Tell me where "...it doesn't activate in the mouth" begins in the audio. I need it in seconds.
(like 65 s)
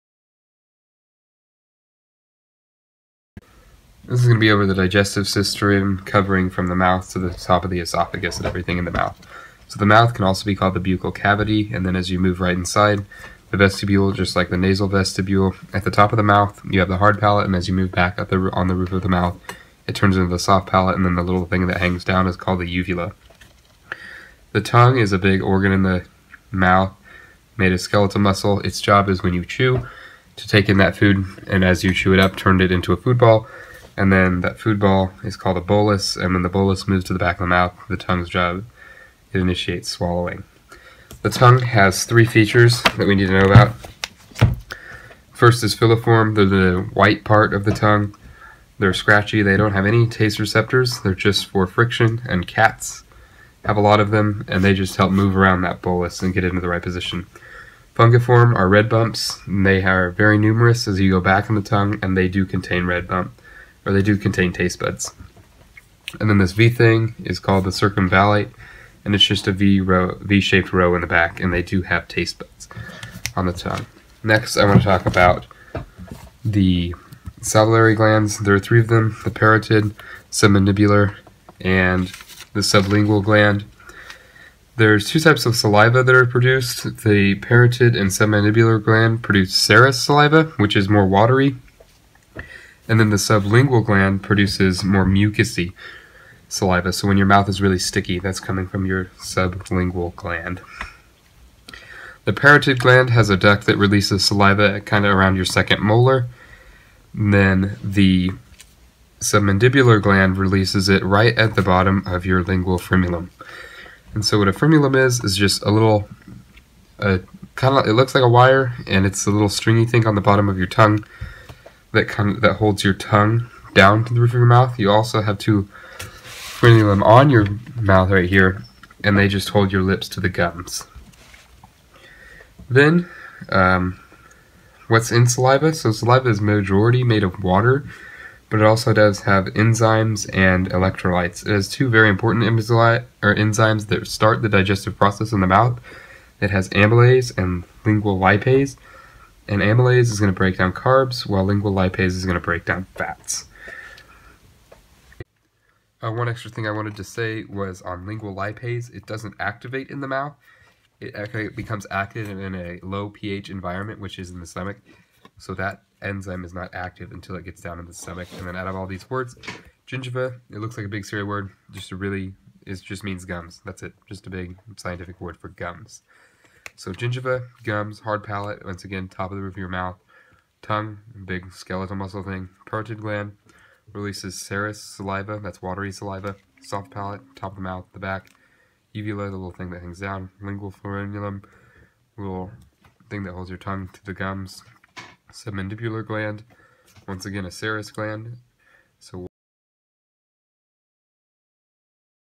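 158 s.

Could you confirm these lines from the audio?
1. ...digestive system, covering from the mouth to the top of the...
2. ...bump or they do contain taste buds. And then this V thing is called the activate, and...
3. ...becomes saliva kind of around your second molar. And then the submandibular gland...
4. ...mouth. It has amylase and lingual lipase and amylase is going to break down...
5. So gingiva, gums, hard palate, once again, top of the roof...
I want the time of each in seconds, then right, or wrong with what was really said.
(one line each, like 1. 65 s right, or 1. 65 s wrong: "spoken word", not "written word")
1. 4 s right
2. 63 s wrong: "circumvallate", not "activate"
3. 103 s wrong: "releases", not "becomes"
4. 145 s right
5. 176 s right.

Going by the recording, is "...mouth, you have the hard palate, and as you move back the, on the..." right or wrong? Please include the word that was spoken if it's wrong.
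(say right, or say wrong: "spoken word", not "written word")
right.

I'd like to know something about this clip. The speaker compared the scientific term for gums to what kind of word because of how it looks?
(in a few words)
Cereal word.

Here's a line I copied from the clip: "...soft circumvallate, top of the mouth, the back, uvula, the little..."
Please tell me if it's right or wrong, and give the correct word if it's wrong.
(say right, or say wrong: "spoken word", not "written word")
wrong: "palate", not "circumvallate".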